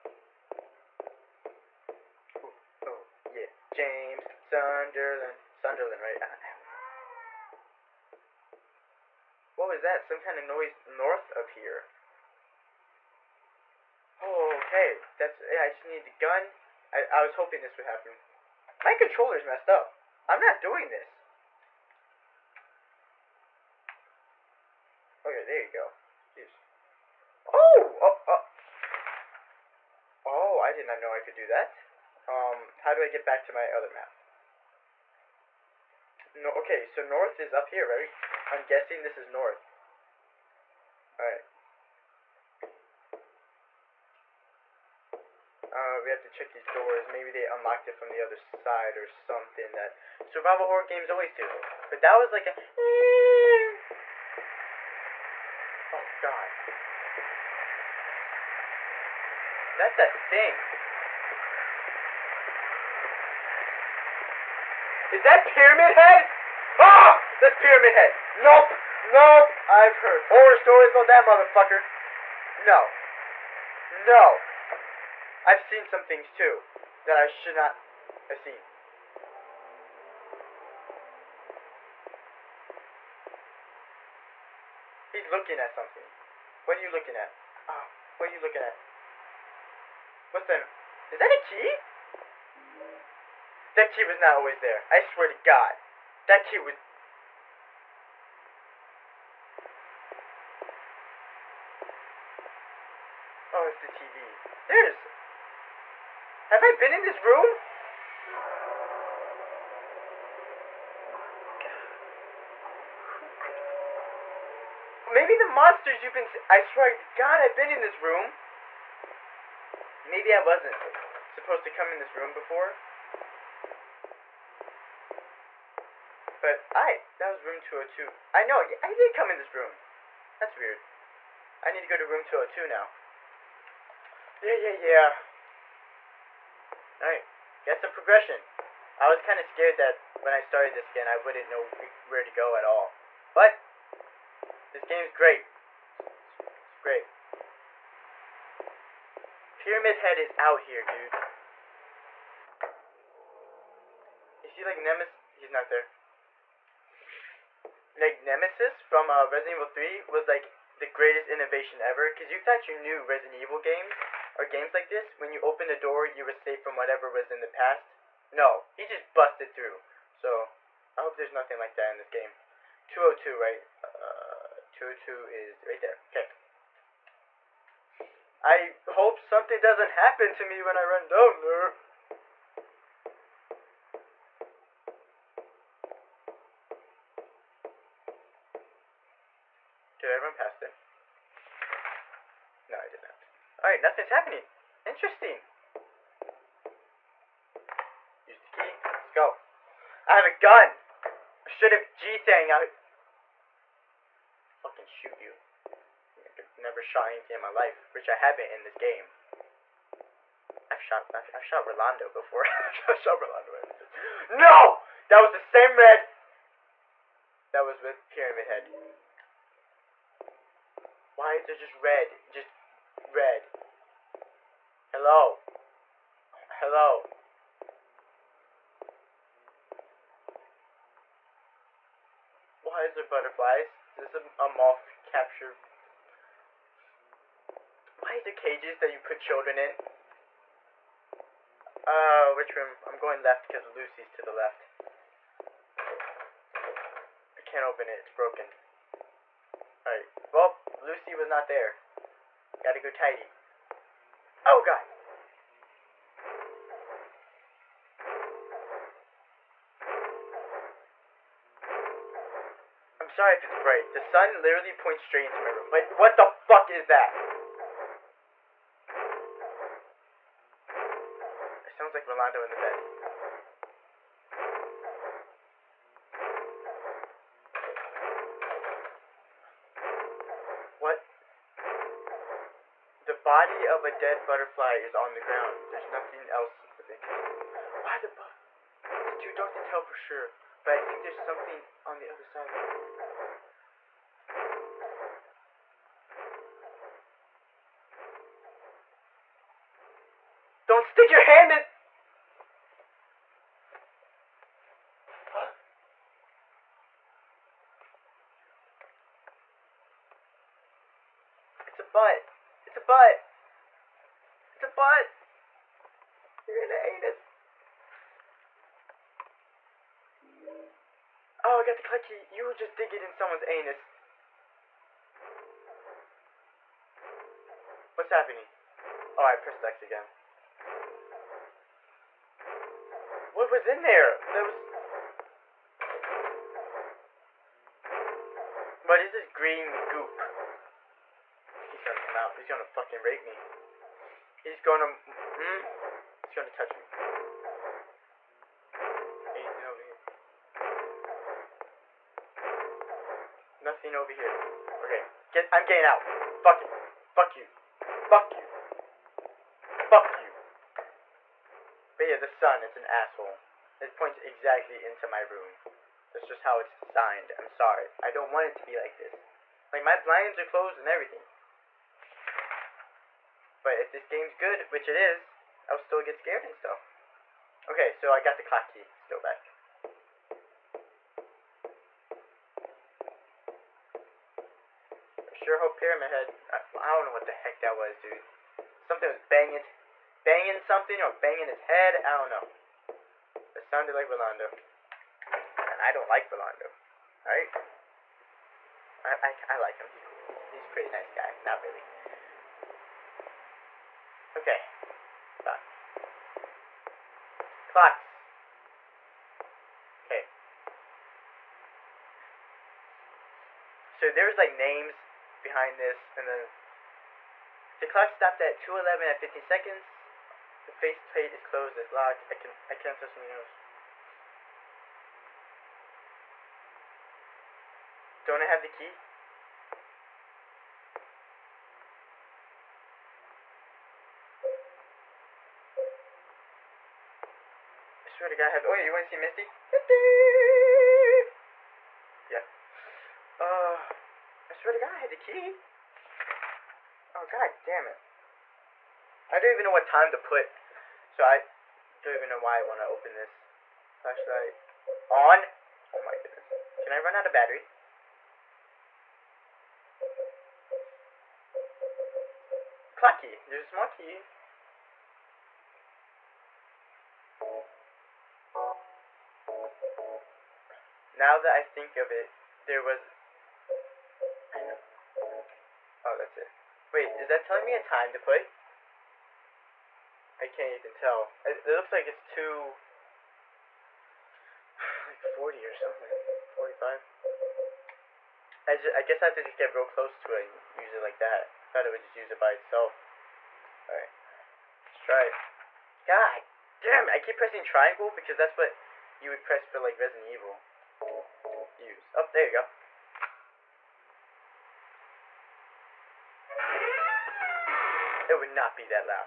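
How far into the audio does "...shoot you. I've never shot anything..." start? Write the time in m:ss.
3:24.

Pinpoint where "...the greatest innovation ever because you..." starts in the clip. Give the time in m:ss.
2:40.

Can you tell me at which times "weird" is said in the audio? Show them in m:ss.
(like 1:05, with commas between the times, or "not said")
2:10.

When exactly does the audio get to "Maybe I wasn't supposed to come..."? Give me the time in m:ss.
2:00.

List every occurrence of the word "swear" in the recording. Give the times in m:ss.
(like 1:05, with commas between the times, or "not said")
1:34, 1:56, 7:18, 7:24.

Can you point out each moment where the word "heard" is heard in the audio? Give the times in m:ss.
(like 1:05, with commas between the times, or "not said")
1:09.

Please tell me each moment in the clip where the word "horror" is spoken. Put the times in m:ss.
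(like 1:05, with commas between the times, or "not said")
0:50, 1:10.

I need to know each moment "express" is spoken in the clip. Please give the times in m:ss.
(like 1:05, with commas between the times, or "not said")
not said.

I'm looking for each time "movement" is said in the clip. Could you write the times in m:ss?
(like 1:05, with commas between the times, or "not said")
not said.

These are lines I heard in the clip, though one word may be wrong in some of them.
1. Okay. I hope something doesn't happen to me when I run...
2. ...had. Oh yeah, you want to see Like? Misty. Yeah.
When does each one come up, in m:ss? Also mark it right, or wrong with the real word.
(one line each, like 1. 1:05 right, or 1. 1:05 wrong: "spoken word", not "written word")
1. 2:56 right
2. 7:18 wrong: "Misty", not "Like".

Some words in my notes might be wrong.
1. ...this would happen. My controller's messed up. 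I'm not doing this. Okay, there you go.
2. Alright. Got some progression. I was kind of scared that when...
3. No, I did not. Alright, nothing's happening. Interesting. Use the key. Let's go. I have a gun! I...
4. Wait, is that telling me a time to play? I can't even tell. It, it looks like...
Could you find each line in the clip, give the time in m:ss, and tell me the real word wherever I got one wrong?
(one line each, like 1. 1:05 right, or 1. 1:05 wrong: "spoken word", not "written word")
1. 0:17 right
2. 2:16 right
3. 3:12 right
4. 7:56 right.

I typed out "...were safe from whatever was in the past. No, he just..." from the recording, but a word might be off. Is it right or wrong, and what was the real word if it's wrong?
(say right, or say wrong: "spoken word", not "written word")
right.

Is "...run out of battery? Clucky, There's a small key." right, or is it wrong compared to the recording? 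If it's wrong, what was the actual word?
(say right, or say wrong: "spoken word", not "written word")
right.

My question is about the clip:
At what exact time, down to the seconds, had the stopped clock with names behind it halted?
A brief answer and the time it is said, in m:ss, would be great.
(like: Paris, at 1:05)
2:11 and 15 seconds, at 6:58.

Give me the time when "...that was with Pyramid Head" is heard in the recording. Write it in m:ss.
3:37.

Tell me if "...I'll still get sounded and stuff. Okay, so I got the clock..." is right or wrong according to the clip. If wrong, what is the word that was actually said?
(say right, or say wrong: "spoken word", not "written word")
wrong: "scared", not "sounded".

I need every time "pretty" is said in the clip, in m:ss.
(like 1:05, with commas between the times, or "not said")
6:40.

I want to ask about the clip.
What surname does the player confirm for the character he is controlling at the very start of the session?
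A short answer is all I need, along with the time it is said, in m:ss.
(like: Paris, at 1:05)
Sunderland, at 0:03.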